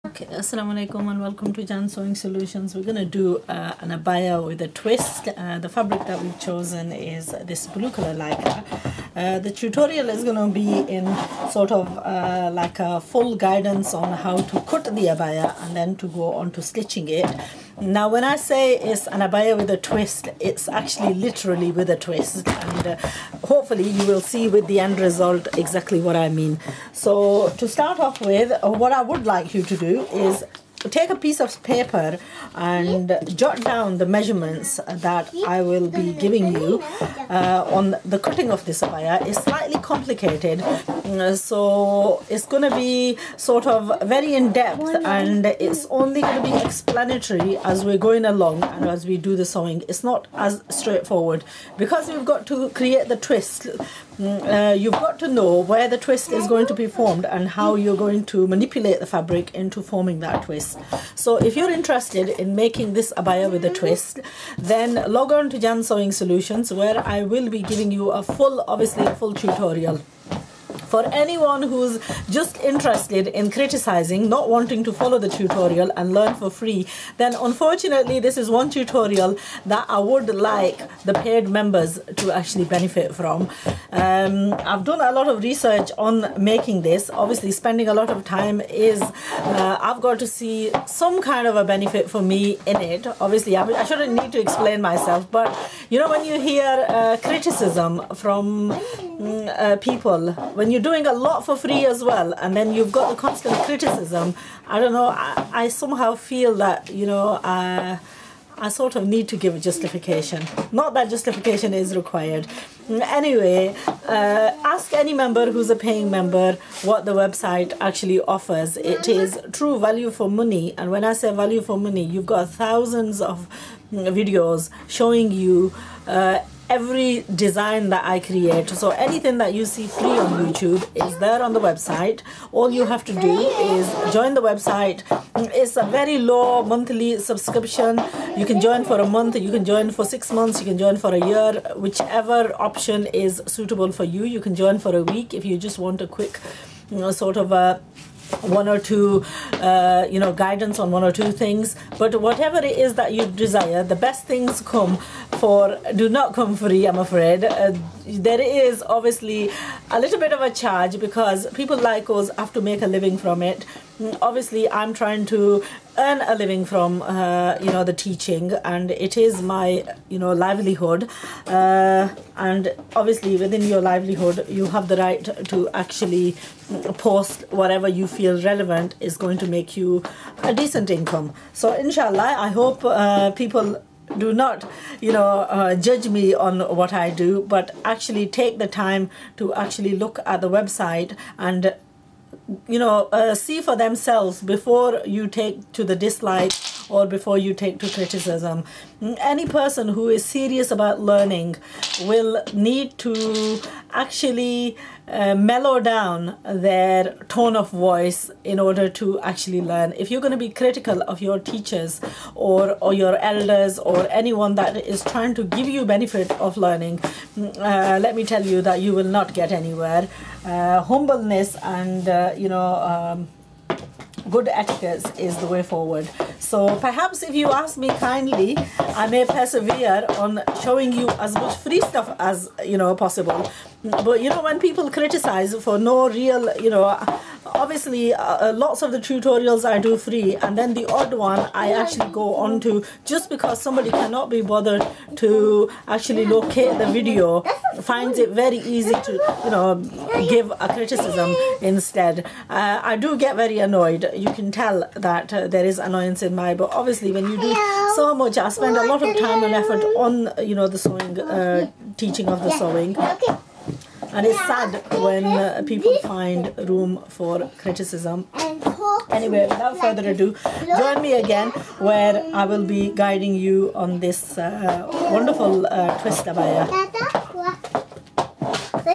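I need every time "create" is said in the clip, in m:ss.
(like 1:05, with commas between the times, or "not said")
0:52, 2:08.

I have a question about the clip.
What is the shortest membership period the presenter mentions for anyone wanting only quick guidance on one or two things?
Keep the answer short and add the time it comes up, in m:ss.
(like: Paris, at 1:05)
A week, at 2:24.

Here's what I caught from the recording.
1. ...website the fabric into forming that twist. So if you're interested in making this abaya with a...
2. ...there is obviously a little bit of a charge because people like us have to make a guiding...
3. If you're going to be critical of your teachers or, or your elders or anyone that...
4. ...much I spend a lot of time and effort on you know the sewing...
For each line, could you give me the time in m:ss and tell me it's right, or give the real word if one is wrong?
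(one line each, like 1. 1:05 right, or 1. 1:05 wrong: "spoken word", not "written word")
1. 0:58 wrong: "manipulate", not "website"
2. 2:38 wrong: "living", not "guiding"
3. 3:29 right
4. 4:18 right.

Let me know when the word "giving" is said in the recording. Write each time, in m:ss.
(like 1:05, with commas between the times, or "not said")
0:36, 1:07.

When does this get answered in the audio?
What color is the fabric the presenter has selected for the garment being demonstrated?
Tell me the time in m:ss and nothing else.
0:07.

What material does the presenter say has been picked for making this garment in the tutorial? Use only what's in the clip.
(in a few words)
Lycra.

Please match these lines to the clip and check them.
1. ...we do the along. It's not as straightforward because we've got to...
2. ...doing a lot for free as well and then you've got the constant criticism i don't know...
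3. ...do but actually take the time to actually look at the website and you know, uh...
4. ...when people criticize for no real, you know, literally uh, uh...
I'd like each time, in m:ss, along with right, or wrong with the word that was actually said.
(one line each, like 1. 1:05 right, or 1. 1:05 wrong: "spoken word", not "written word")
1. 0:49 wrong: "sewing", not "along"
2. 1:40 right
3. 3:07 right
4. 3:54 wrong: "obviously", not "literally".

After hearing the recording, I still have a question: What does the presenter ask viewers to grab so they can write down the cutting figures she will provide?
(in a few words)
A piece of paper.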